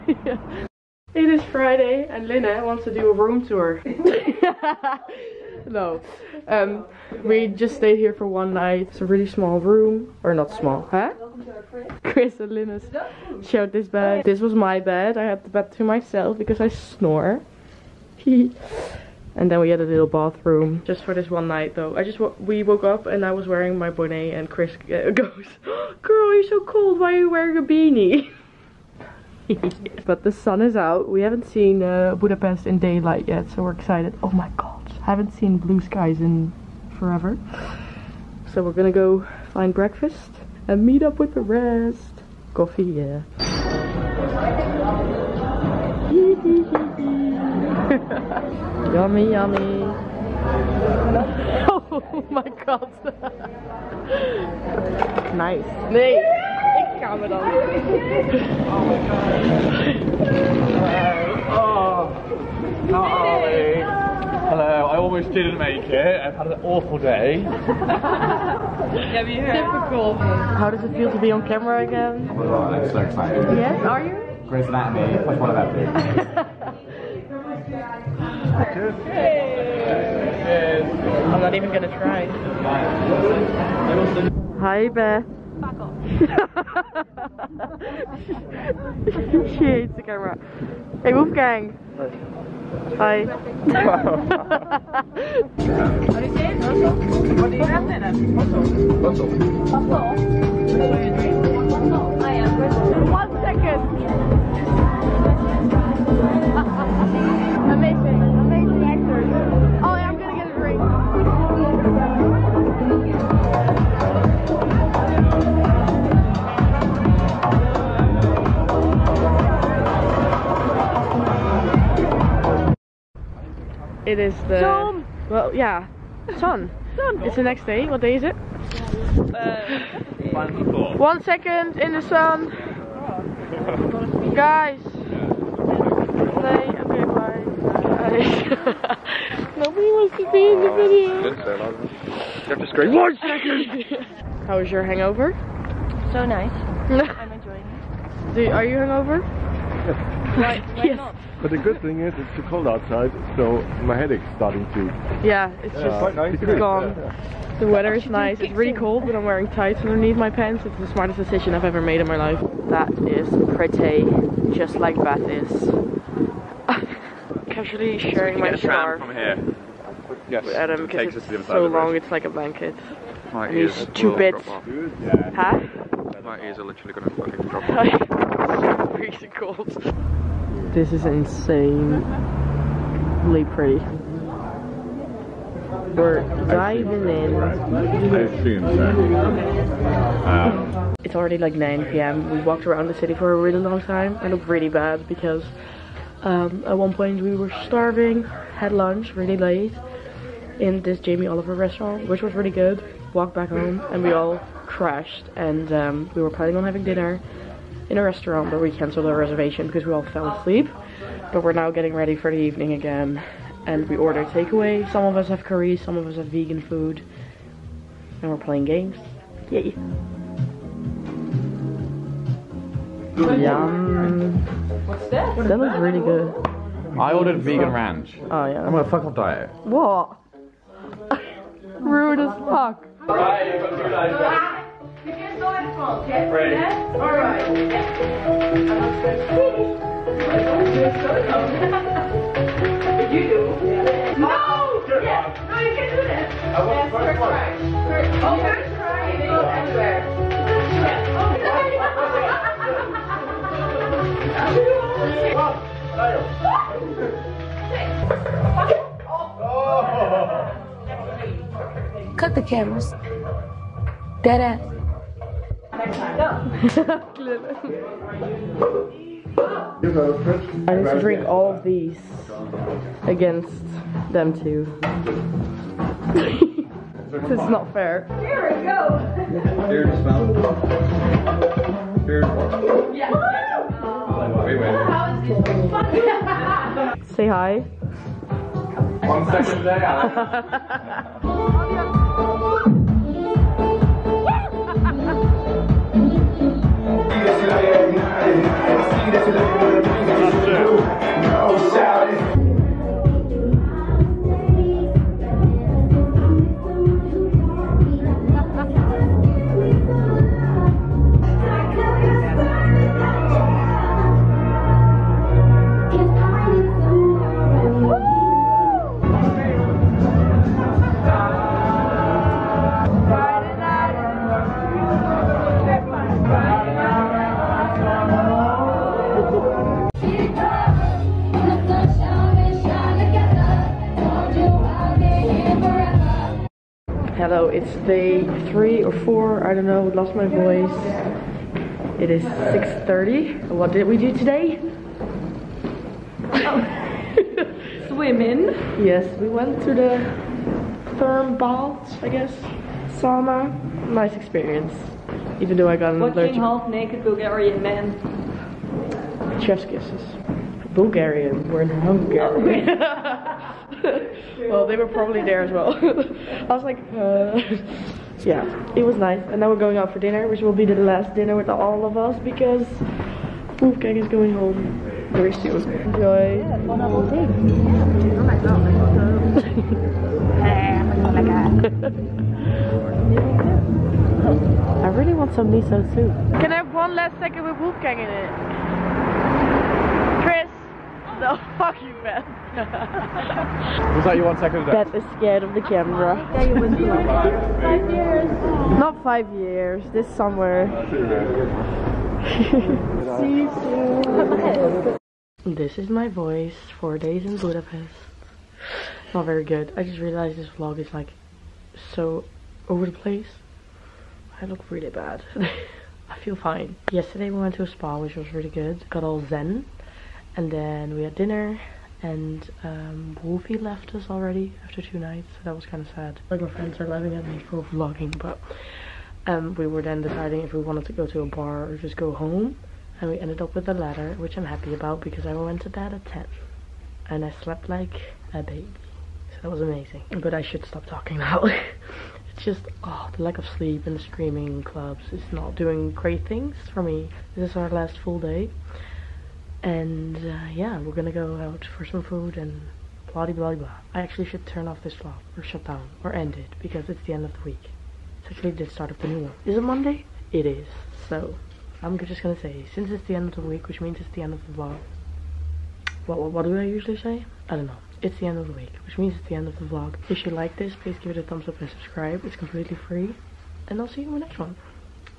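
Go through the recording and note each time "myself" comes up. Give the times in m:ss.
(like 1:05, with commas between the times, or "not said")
0:15.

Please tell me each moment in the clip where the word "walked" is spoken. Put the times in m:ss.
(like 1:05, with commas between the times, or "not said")
3:12, 3:23.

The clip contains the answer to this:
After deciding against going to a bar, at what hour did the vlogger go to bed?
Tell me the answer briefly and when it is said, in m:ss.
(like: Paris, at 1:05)
10, at 7:16.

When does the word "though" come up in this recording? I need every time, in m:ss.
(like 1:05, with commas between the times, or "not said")
0:21, 5:55.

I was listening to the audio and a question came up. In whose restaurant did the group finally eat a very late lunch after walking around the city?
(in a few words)
Jamie Oliver.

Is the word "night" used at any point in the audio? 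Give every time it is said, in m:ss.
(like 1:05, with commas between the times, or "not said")
0:08, 0:21, 7:04.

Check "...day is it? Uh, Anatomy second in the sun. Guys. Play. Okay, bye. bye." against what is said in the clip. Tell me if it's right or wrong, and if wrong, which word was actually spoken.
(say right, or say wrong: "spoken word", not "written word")
wrong: "One", not "Anatomy".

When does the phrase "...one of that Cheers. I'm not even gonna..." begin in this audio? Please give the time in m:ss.
1:15.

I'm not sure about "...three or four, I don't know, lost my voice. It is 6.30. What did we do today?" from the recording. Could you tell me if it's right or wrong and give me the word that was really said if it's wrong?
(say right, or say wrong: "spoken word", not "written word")
right.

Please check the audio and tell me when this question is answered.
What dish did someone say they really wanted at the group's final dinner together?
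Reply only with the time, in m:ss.
6:25.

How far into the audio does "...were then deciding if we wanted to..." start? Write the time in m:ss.
7:09.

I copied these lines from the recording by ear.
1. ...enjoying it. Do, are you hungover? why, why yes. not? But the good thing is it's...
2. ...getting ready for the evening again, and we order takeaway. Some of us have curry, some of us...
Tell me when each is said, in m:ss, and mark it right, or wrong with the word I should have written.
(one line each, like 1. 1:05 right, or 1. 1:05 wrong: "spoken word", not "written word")
1. 2:27 right
2. 3:31 right.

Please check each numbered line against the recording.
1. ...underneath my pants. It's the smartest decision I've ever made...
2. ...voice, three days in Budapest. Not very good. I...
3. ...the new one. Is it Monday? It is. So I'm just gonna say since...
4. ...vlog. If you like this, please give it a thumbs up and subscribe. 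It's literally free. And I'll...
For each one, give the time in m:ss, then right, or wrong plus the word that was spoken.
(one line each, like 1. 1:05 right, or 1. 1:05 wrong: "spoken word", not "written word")
1. 2:39 right
2. 6:46 wrong: "four", not "three"
3. 7:38 right
4. 7:49 wrong: "completely", not "literally".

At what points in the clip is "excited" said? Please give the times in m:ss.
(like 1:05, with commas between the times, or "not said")
0:33, 1:12.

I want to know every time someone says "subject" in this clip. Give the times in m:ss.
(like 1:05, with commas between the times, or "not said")
not said.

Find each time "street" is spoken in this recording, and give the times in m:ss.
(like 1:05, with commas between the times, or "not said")
not said.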